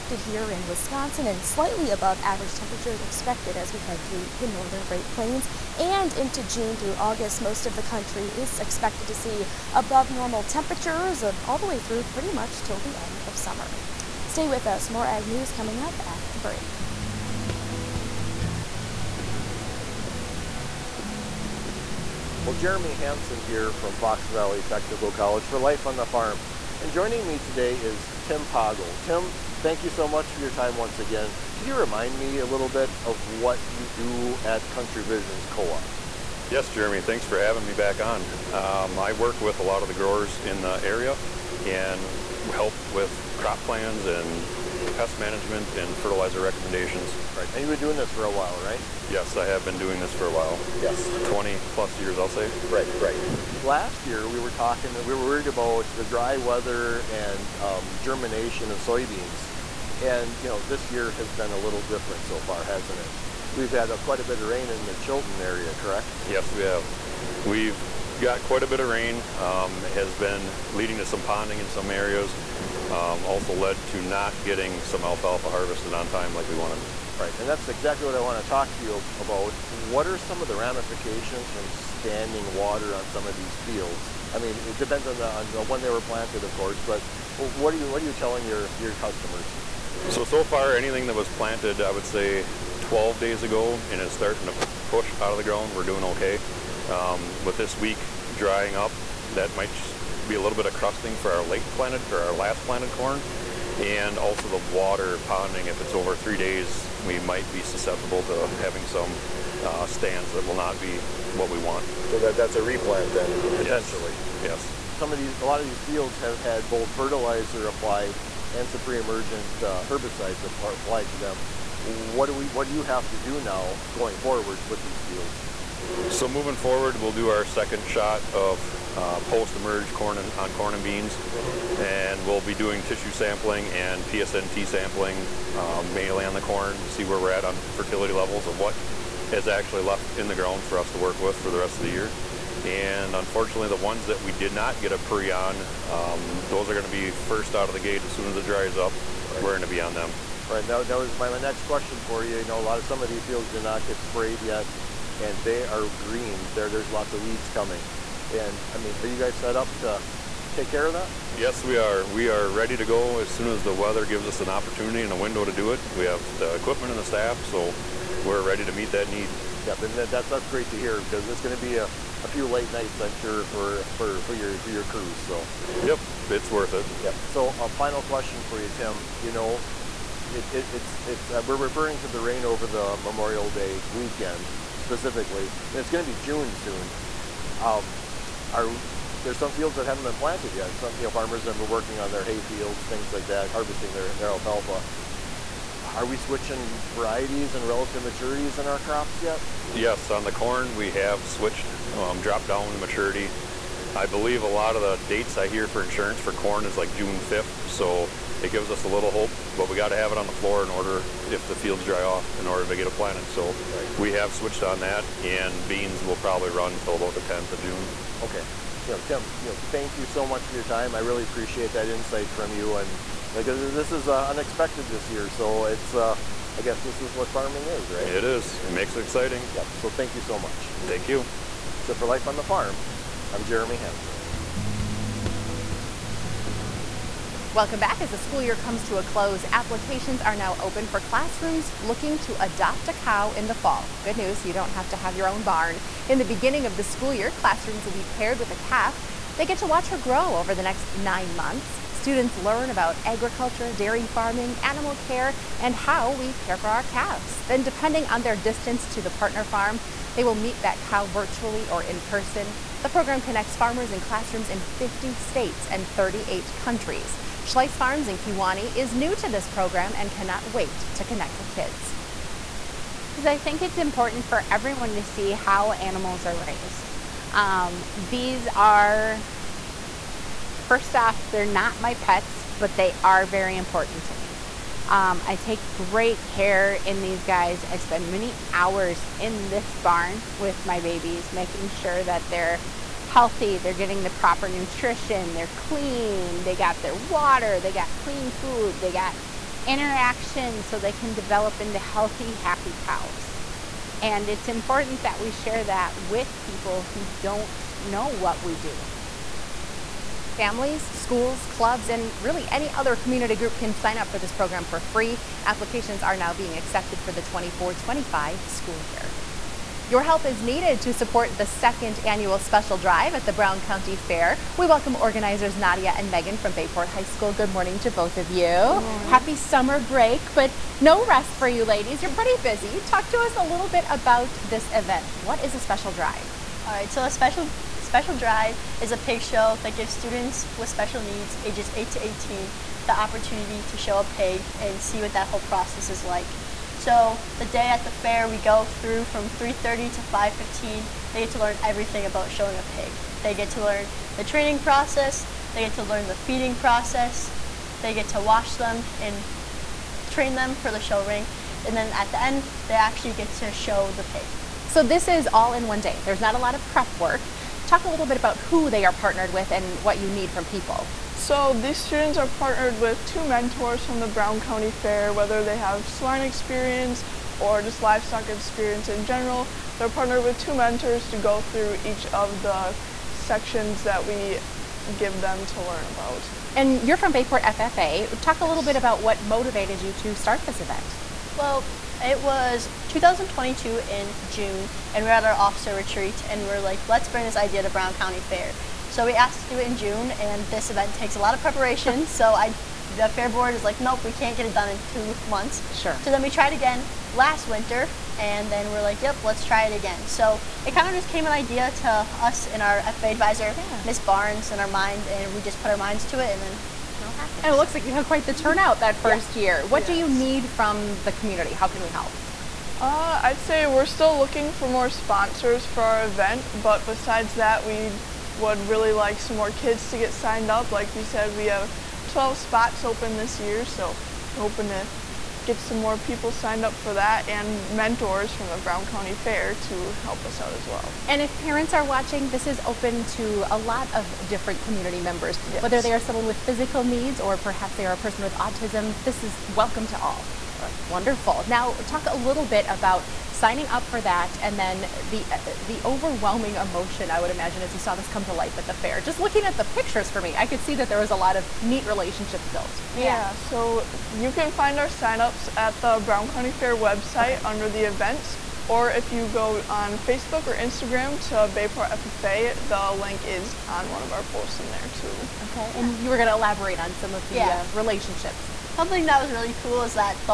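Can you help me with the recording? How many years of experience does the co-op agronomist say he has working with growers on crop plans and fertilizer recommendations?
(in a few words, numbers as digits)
20 plus years.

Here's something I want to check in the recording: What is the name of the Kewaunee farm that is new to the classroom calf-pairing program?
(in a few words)
Schleiss Farms.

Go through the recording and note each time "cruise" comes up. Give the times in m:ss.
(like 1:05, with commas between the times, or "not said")
not said.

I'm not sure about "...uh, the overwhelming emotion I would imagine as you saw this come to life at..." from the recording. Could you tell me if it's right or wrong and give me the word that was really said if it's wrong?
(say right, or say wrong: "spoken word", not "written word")
right.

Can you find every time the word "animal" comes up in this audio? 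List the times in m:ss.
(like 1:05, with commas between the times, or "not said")
4:14, 4:35.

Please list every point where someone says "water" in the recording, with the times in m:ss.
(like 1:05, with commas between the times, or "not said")
1:22, 1:44, 4:56.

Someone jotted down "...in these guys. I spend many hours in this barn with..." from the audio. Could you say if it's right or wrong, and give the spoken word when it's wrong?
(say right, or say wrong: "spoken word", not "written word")
right.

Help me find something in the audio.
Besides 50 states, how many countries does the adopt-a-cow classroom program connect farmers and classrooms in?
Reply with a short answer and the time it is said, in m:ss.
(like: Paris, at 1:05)
38, at 4:25.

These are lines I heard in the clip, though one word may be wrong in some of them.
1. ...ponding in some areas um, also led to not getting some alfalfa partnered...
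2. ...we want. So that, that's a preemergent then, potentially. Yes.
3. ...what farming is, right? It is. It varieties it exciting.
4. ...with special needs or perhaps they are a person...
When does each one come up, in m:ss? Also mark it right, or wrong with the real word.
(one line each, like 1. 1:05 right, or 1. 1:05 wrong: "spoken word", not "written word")
1. 1:11 wrong: "harvested", not "partnered"
2. 1:51 wrong: "replant", not "preemergent"
3. 3:47 wrong: "makes", not "varieties"
4. 7:26 wrong: "physical", not "special".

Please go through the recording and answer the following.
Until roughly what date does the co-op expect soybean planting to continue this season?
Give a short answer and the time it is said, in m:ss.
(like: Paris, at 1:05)
June 10th, at 3:37.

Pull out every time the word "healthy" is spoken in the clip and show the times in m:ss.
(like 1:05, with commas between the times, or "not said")
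4:53, 5:01.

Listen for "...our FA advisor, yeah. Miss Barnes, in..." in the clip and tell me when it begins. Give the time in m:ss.
6:52.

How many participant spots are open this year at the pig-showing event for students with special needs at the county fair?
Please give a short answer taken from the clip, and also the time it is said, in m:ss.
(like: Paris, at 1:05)
12, at 7:12.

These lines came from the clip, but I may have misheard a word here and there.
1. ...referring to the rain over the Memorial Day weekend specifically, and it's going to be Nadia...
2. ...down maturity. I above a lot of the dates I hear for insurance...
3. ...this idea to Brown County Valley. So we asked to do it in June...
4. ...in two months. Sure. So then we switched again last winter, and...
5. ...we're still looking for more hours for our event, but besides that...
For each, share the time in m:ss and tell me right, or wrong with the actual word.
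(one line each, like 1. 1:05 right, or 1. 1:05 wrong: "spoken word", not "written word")
1. 3:01 wrong: "June", not "Nadia"
2. 3:22 wrong: "believe", not "above"
3. 6:37 wrong: "Fair", not "Valley"
4. 6:44 wrong: "tried", not "switched"
5. 7:03 wrong: "sponsors", not "hours".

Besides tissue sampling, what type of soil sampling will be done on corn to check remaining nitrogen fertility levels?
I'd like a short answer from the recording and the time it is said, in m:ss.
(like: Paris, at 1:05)
PSNT sampling, at 2:14.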